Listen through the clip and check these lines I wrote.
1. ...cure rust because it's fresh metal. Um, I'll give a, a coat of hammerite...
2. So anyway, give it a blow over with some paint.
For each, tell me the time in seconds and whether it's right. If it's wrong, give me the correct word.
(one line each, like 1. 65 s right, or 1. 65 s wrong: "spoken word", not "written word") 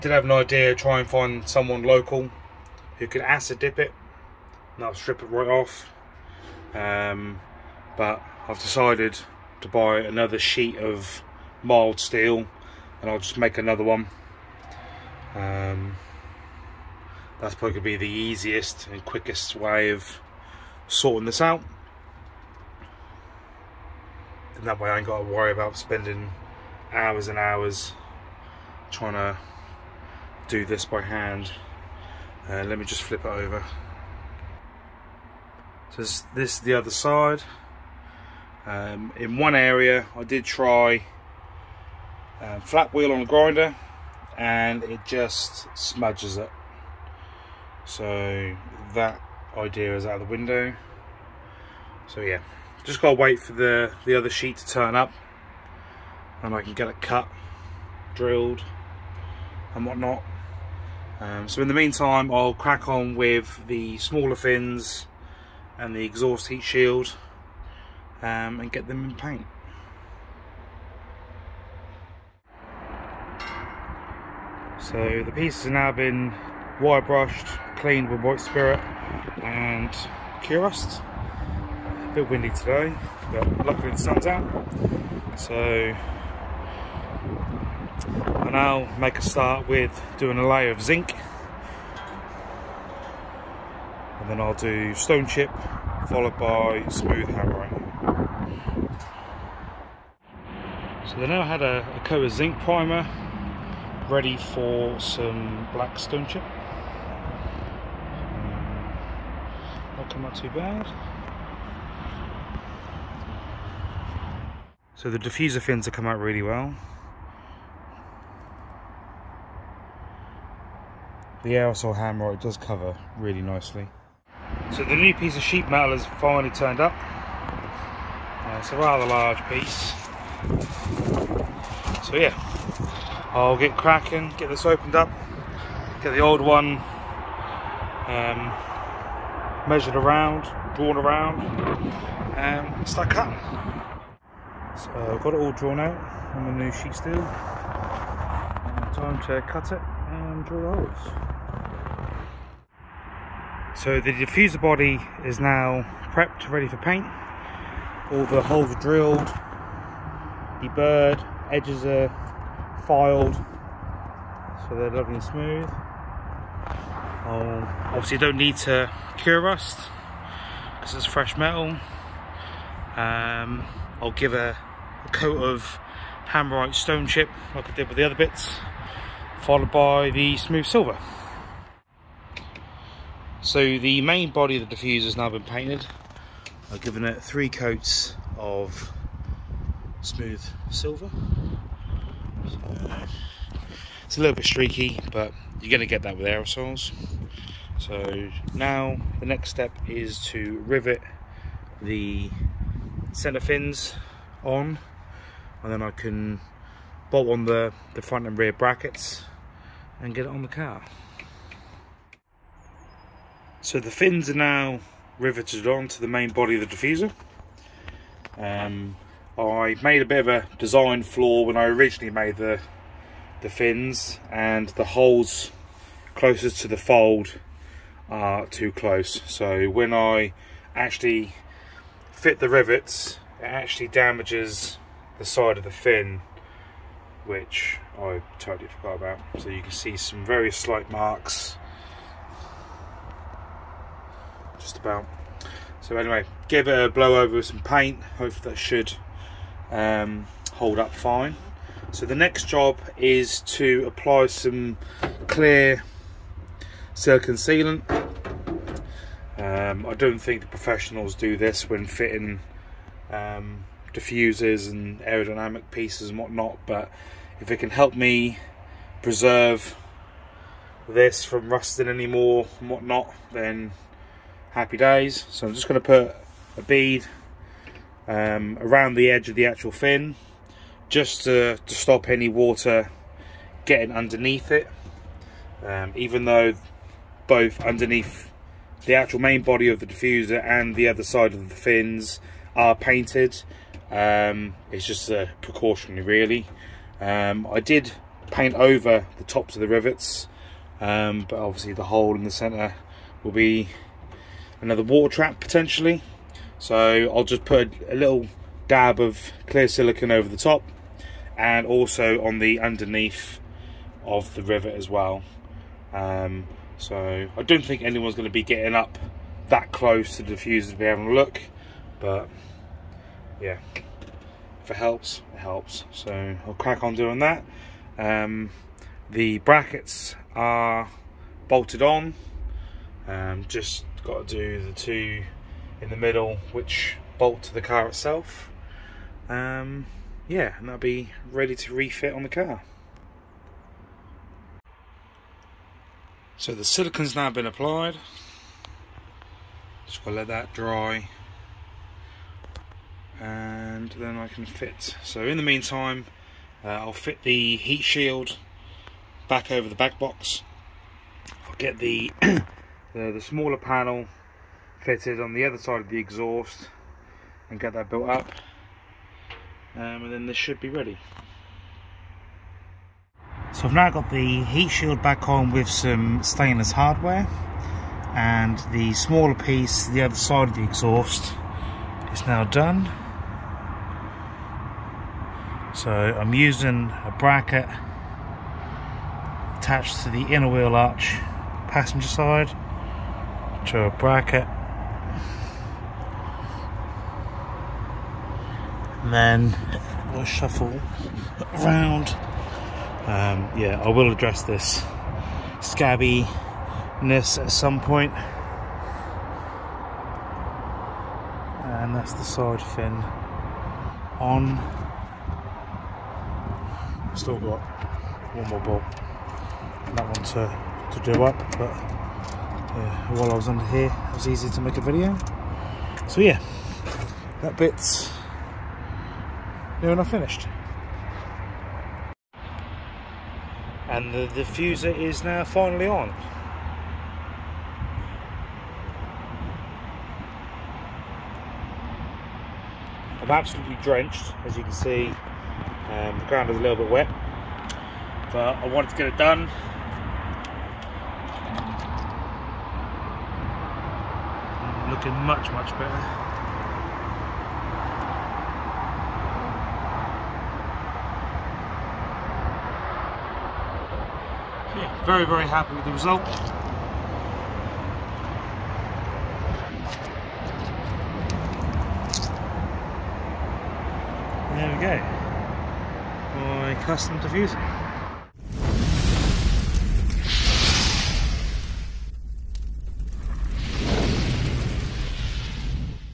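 1. 169 s right
2. 245 s right.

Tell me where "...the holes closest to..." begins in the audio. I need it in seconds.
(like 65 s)
224 s.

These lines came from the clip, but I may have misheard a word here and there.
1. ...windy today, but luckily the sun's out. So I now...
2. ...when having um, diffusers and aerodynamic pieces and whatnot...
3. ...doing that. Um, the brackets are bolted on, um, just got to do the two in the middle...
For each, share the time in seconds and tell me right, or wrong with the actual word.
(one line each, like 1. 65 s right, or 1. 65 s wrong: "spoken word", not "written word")
1. 82 s right
2. 261 s wrong: "fitting", not "having"
3. 326 s right.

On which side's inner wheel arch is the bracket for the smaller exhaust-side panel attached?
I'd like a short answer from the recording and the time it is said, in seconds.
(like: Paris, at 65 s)
passenger side, at 391 s.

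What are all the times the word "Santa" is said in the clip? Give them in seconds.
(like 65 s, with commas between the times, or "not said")
not said.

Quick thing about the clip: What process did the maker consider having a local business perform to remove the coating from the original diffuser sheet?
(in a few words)
acid dip.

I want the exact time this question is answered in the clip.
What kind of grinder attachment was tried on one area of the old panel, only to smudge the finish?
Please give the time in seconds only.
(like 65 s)
42 s.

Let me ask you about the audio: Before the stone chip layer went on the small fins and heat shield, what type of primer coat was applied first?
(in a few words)
zinc primer.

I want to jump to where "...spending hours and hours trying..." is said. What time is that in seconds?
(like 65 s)
25 s.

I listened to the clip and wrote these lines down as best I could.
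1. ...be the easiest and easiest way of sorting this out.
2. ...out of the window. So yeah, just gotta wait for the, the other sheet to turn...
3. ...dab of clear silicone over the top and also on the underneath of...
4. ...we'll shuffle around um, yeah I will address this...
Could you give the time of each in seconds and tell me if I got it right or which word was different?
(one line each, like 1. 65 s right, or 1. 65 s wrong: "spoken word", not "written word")
1. 17 s wrong: "quickest", not "easiest"
2. 50 s right
3. 308 s right
4. 400 s right.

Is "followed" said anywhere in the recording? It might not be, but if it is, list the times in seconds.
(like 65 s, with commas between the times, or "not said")
96 s, 179 s.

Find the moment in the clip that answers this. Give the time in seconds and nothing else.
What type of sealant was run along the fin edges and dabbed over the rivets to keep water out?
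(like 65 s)
255 s.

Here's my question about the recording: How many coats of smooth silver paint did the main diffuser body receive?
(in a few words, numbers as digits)
3.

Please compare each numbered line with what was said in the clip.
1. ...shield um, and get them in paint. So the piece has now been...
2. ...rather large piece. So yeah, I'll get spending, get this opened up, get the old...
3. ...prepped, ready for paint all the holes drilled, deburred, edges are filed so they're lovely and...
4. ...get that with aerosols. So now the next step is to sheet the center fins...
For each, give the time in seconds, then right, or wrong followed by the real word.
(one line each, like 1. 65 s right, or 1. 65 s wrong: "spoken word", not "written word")
1. 66 s right
2. 128 s wrong: "cracking", not "spending"
3. 156 s right
4. 195 s wrong: "rivet", not "sheet".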